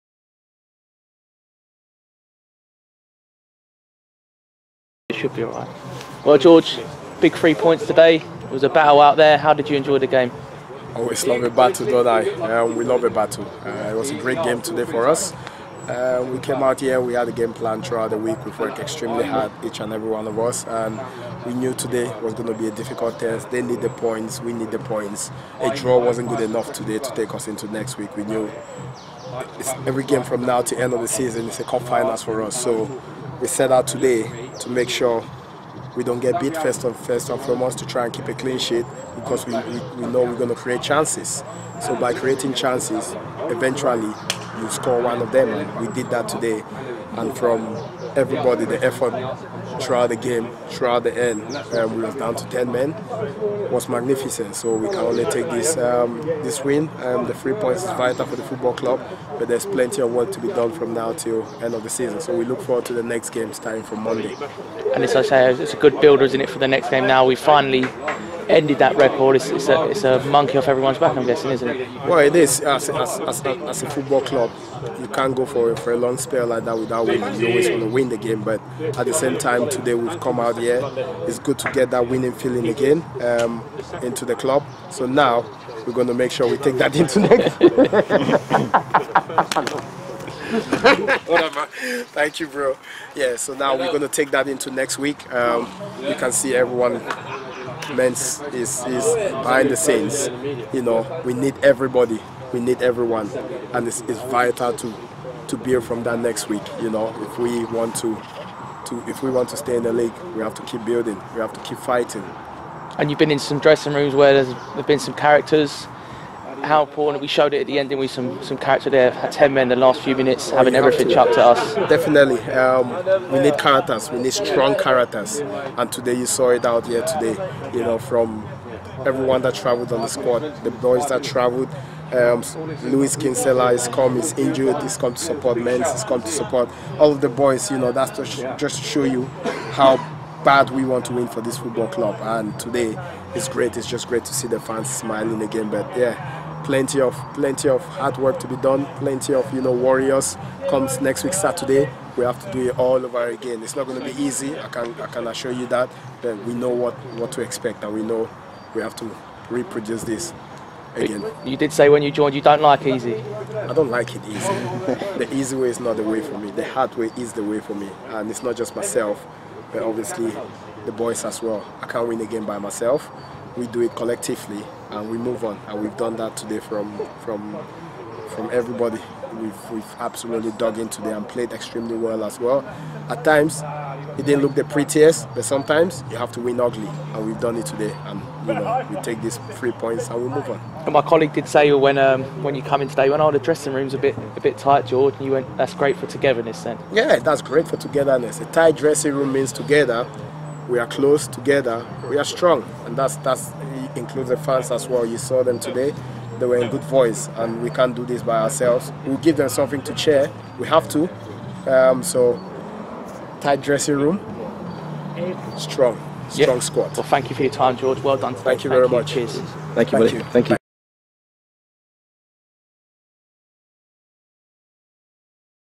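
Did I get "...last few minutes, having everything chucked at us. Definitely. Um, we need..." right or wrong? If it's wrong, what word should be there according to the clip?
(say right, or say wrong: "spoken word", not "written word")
right.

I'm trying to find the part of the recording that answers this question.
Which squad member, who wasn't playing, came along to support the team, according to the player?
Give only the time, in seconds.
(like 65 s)
132 s.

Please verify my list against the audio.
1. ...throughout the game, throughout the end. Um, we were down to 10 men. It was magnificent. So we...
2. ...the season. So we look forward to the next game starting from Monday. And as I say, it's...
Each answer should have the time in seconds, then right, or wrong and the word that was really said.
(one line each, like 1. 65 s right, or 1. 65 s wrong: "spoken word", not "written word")
1. 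49 s right
2. 61 s right.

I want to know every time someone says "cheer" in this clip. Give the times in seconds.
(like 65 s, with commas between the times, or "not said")
209 s, 219 s.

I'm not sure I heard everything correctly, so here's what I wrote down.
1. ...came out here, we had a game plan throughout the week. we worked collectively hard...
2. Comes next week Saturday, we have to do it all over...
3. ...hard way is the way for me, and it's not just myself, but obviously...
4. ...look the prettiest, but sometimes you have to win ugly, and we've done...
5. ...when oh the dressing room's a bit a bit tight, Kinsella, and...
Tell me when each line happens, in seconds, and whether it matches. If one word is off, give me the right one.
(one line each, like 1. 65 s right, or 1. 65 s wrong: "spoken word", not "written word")
1. 16 s wrong: "extremely", not "collectively"
2. 150 s right
3. 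166 s right
4. 184 s right
5. 193 s wrong: "George", not "Kinsella".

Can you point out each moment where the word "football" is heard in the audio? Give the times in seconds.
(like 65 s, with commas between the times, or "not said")
58 s, 73 s, 141 s.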